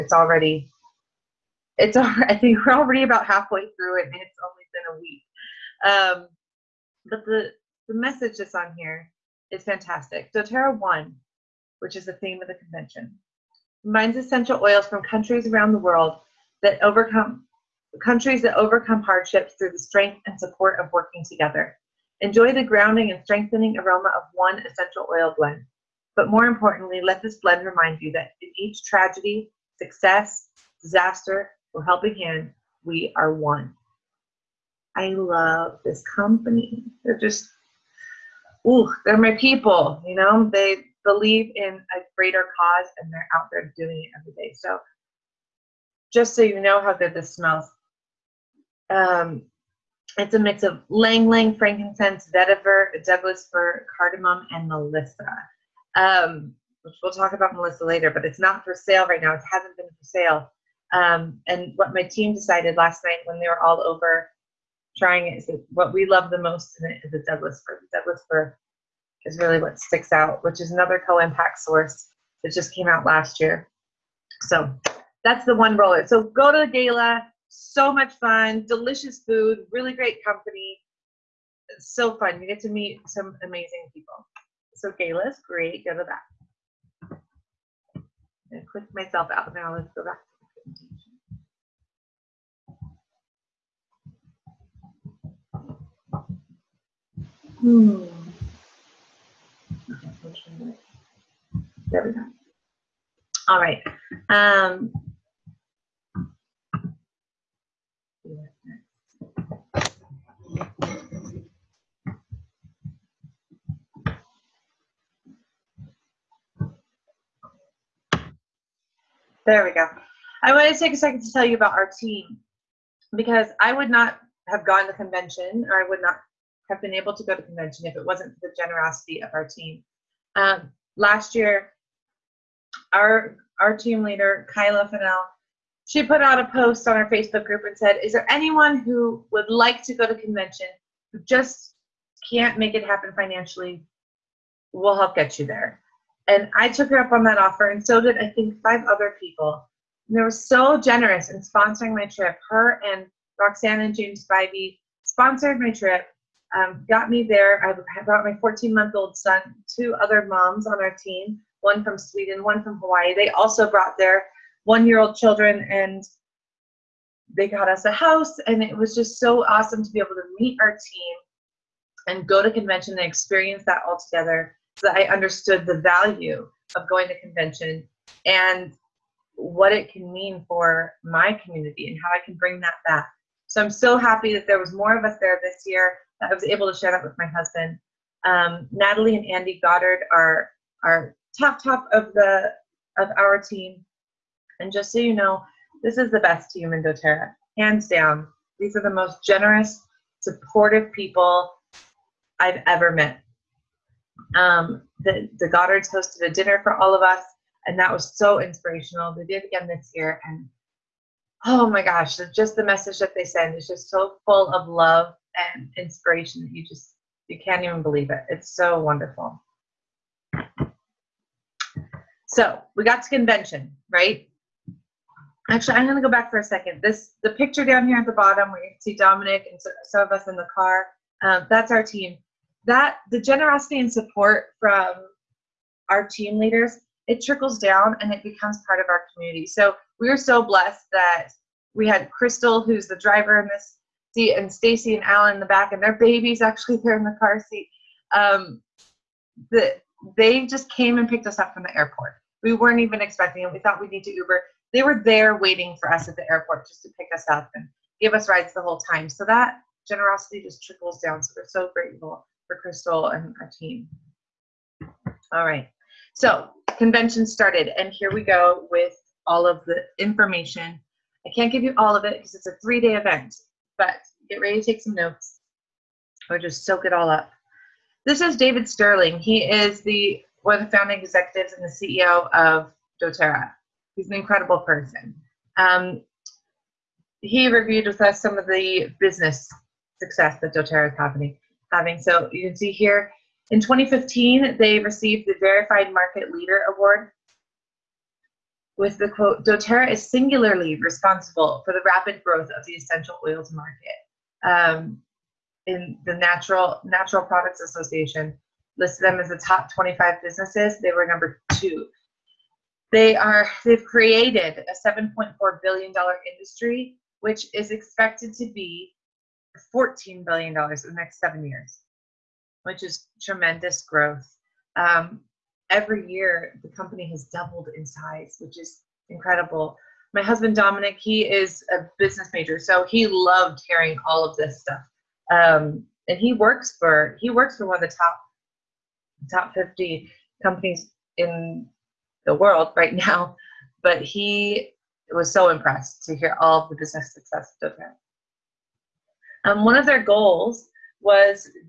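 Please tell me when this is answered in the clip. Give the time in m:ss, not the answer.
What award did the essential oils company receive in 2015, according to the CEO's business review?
4:55.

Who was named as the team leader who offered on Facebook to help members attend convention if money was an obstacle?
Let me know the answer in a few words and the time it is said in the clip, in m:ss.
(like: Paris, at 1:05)
Kyla Fennell, at 2:14.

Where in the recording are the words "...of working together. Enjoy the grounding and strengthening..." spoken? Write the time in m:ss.
0:20.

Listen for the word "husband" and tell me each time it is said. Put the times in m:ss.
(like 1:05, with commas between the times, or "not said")
3:07, 5:30.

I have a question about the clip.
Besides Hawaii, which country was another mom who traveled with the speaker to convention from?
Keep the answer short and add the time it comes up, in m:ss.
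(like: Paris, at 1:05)
Sweden, at 2:41.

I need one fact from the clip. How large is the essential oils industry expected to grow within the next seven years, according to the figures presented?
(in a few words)
14 billion dollars.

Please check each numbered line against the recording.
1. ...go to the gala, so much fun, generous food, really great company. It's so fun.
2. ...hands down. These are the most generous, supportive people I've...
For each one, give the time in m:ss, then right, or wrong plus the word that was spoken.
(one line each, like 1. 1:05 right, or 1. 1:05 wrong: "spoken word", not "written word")
1. 1:16 wrong: "delicious", not "generous"
2. 3:17 right.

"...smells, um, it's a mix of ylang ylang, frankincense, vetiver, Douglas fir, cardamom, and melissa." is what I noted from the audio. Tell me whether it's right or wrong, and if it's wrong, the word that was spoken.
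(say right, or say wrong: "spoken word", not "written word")
right.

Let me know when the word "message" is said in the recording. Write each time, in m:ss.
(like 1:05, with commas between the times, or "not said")
0:07, 3:32.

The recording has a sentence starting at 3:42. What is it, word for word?
So we got to convention, right?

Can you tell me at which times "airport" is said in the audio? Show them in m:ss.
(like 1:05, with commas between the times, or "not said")
4:11, 4:16.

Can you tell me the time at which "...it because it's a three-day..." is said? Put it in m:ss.
4:32.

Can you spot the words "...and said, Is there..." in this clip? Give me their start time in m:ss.
2:17.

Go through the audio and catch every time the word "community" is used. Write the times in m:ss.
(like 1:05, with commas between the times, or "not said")
3:01, 3:59.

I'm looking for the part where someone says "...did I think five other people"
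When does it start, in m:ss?
2:27.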